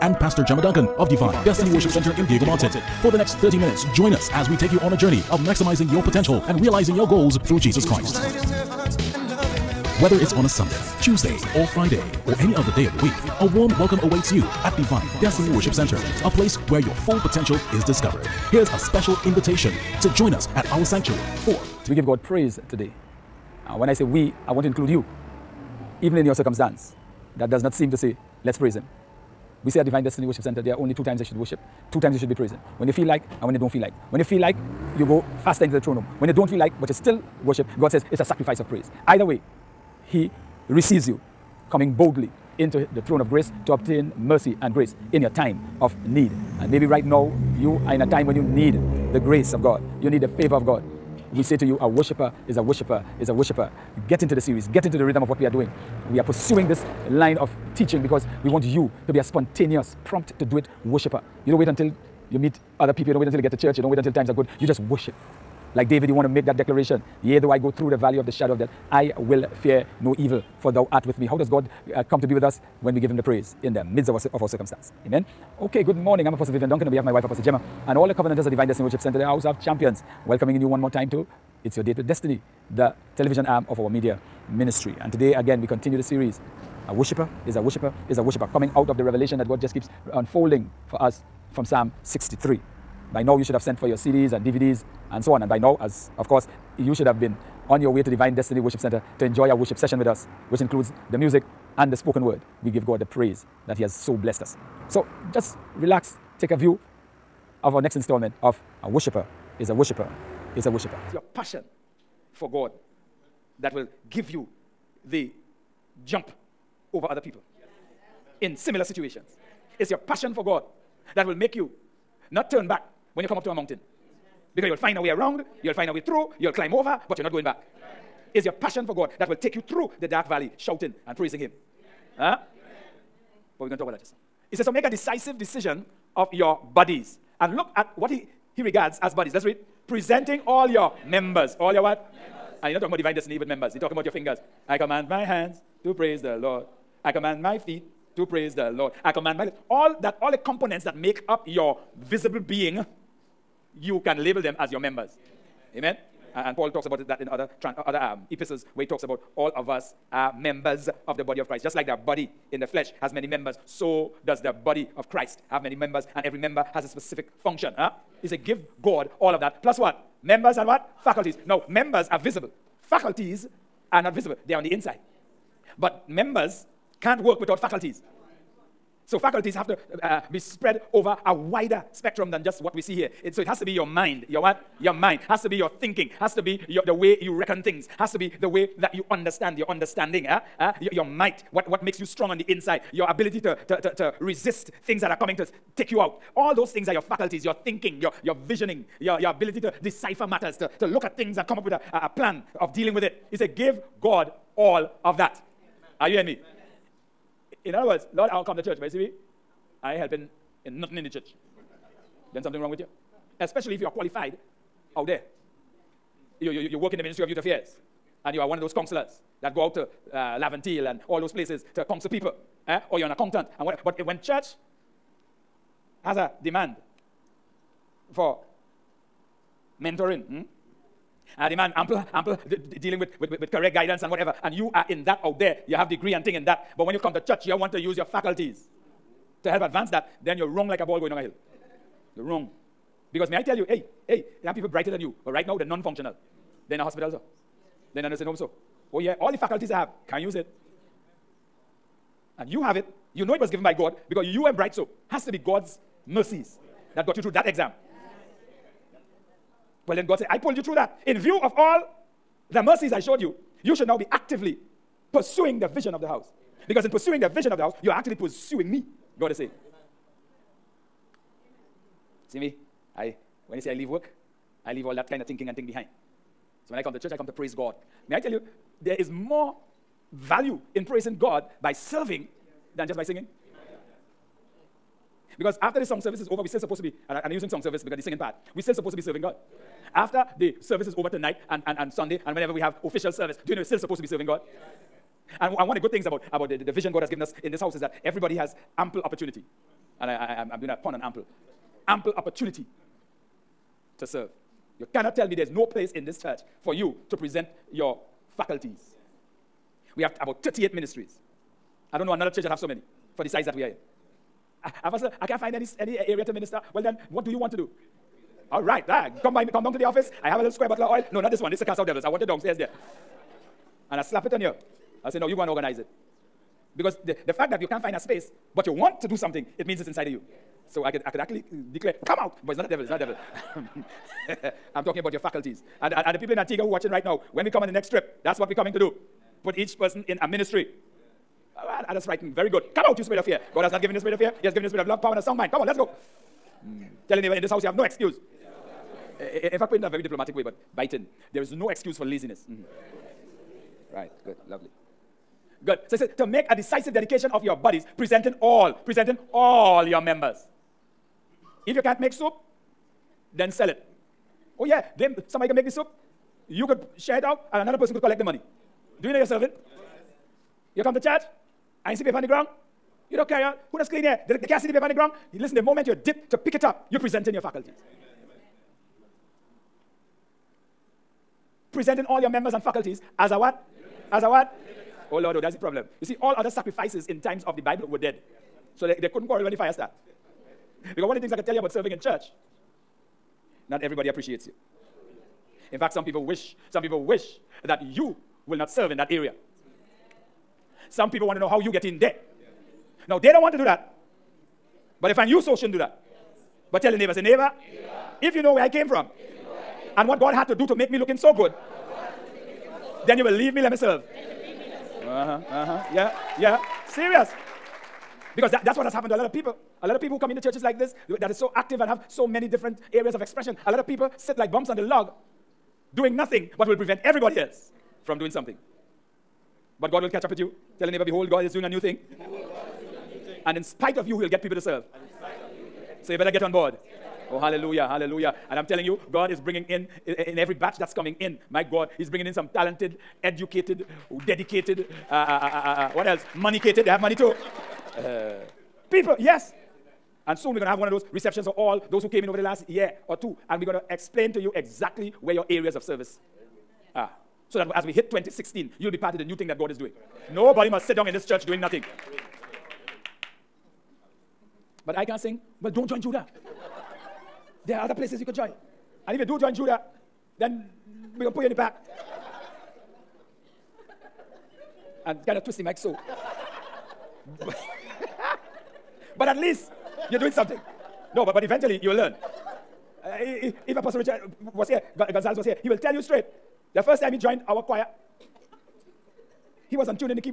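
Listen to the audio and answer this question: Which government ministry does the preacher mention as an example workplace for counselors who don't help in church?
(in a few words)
Ministry of Youth Affairs.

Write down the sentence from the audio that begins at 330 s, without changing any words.
So I could, I could actually uh, declare, come out, but it's not a devil, it's not a devil.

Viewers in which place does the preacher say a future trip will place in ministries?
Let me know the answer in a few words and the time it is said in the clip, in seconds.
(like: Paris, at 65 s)
Antigua, at 336 s.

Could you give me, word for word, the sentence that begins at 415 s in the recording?
Uh huh, uh huh, yeah, yeah.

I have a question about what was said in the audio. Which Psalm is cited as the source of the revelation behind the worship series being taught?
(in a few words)
Psalm 63.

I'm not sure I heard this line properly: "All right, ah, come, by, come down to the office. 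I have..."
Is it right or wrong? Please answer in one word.
right.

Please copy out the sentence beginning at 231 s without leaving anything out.
uh, demand ample, ample de de dealing with, with, with, with, correct guidance and whatever.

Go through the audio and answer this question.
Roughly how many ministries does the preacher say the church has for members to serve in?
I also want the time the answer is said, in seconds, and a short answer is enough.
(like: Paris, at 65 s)
38, at 310 s.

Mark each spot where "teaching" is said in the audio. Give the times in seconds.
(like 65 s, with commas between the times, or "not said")
57 s.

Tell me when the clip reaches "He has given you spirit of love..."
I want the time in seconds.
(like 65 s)
344 s.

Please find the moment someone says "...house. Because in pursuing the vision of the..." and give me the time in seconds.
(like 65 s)
266 s.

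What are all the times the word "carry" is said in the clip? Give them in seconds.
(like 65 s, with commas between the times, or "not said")
373 s.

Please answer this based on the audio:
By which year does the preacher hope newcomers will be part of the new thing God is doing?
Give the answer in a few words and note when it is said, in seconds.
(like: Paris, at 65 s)
2016, at 458 s.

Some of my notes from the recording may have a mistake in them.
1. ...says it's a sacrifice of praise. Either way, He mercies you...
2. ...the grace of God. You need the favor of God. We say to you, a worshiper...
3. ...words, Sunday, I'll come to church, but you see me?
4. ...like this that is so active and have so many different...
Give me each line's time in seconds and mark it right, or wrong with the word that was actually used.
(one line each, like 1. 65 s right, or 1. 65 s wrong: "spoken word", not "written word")
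1. 37 s wrong: "receives", not "mercies"
2. 49 s right
3. 207 s wrong: "Lord", not "Sunday"
4. 420 s right.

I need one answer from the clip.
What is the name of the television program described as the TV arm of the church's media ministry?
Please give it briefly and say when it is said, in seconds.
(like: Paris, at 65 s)
It's Your Date with Destiny, at 81 s.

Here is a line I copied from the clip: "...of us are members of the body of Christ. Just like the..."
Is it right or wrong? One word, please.
right.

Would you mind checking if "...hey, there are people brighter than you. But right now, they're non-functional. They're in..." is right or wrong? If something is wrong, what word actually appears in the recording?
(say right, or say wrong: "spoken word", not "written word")
right.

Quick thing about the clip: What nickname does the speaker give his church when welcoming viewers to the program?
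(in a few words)
House of Champions.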